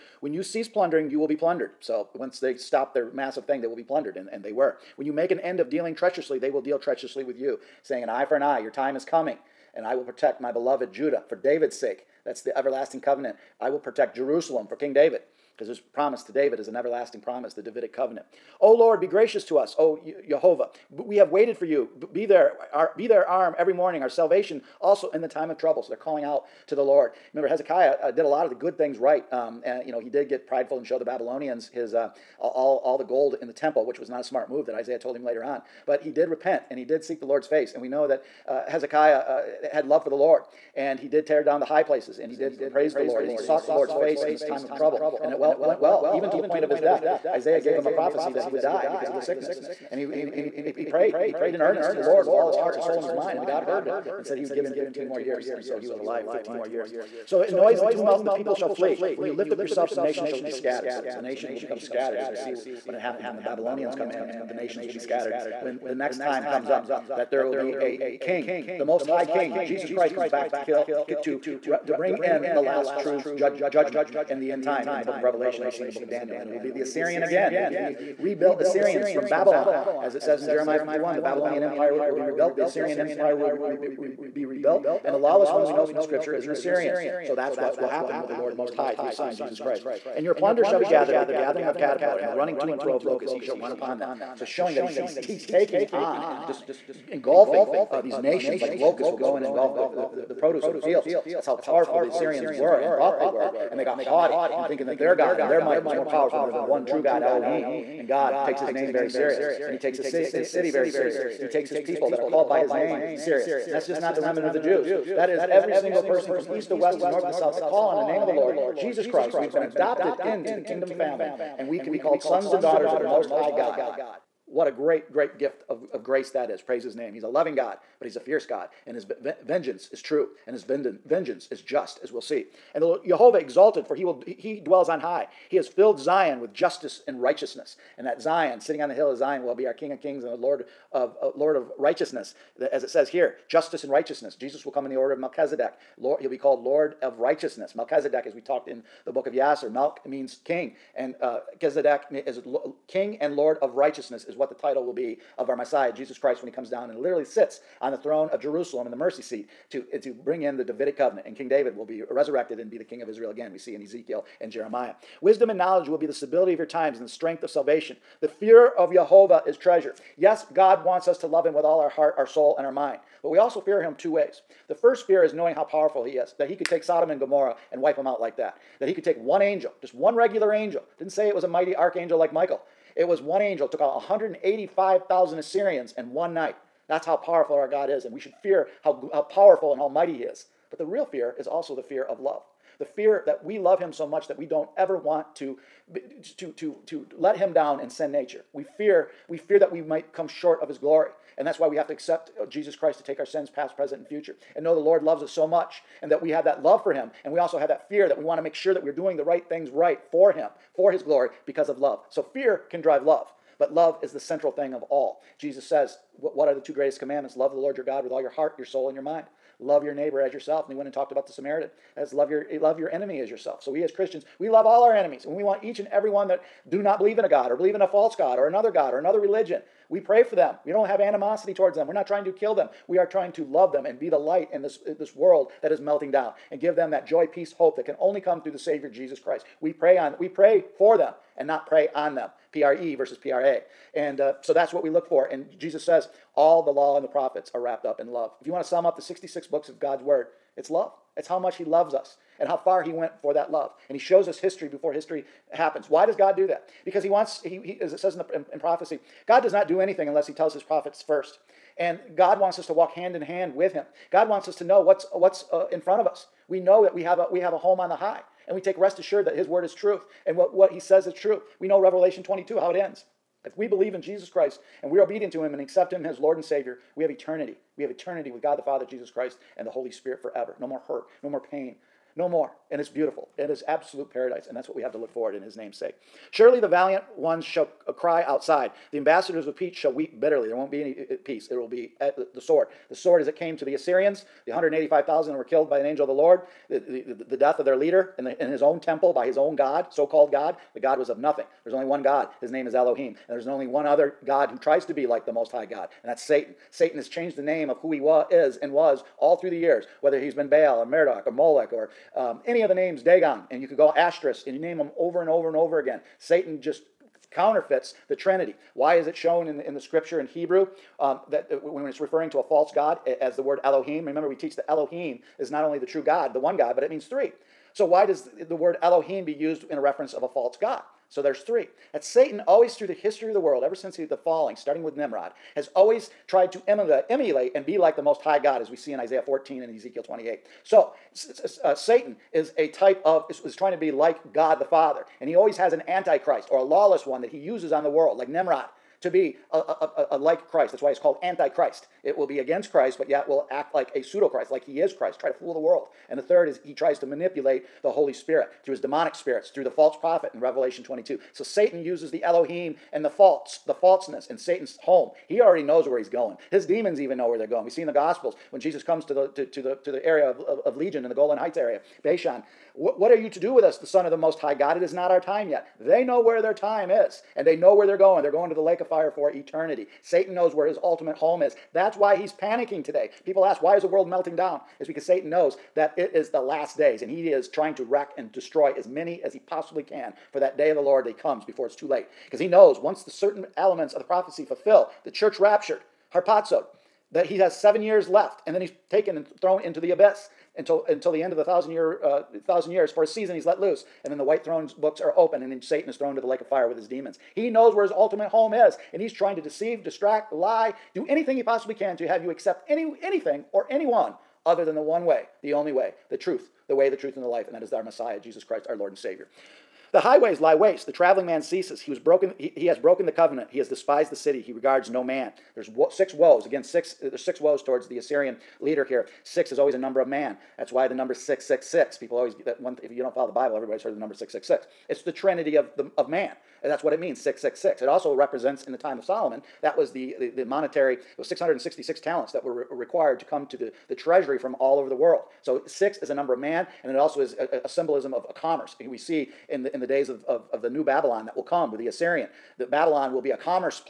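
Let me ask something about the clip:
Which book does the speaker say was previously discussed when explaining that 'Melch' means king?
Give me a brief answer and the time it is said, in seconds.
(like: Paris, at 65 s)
Yasser, at 149 s.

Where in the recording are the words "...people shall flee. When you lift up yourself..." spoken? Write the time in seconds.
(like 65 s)
58 s.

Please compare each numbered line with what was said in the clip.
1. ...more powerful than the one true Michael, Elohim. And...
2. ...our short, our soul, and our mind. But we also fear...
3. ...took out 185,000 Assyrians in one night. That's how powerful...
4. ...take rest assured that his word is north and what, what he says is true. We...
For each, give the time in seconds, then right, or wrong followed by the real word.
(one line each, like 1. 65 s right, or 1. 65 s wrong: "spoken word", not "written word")
1. 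105 s wrong: "God", not "Michael"
2. 171 s wrong: "heart", not "short"
3. 183 s right
4. 268 s wrong: "truth", not "north".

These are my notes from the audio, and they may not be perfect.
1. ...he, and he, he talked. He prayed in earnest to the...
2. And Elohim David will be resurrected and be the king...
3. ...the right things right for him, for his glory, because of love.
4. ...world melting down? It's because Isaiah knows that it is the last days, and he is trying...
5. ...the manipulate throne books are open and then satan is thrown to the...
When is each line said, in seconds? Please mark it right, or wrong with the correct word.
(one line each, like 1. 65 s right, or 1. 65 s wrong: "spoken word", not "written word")
1. 49 s wrong: "prayed", not "talked"
2. 161 s wrong: "King", not "Elohim"
3. 209 s right
4. 383 s wrong: "Satan", not "Isaiah"
5. 404 s wrong: "white", not "manipulate".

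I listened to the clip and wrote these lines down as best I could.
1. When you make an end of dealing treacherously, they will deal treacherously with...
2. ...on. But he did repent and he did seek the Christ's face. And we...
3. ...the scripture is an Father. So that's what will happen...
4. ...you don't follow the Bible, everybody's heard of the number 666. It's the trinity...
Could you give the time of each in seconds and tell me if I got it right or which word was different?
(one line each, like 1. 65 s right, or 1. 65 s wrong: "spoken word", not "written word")
1. 4 s right
2. 35 s wrong: "Lord", not "Christ"
3. 85 s wrong: "Assyrian", not "Father"
4. 432 s right.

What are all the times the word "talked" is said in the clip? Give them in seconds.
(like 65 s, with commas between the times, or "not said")
148 s, 220 s.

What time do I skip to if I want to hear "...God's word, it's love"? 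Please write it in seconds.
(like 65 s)
249 s.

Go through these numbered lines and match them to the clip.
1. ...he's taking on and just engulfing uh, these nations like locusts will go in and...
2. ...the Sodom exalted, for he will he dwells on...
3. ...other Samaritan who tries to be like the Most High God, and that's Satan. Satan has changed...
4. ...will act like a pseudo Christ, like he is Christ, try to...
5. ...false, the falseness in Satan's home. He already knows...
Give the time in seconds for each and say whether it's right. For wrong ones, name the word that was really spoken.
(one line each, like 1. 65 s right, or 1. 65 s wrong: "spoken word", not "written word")
1. 95 s right
2. 132 s wrong: "Jehovah", not "Sodom"
3. 303 s wrong: "God", not "Samaritan"
4. 353 s right
5. 363 s right.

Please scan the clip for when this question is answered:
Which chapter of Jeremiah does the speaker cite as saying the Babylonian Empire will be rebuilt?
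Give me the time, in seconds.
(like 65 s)
80 s.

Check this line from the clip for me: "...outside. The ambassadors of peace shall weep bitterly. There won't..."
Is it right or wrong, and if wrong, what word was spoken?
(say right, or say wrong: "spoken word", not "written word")
right.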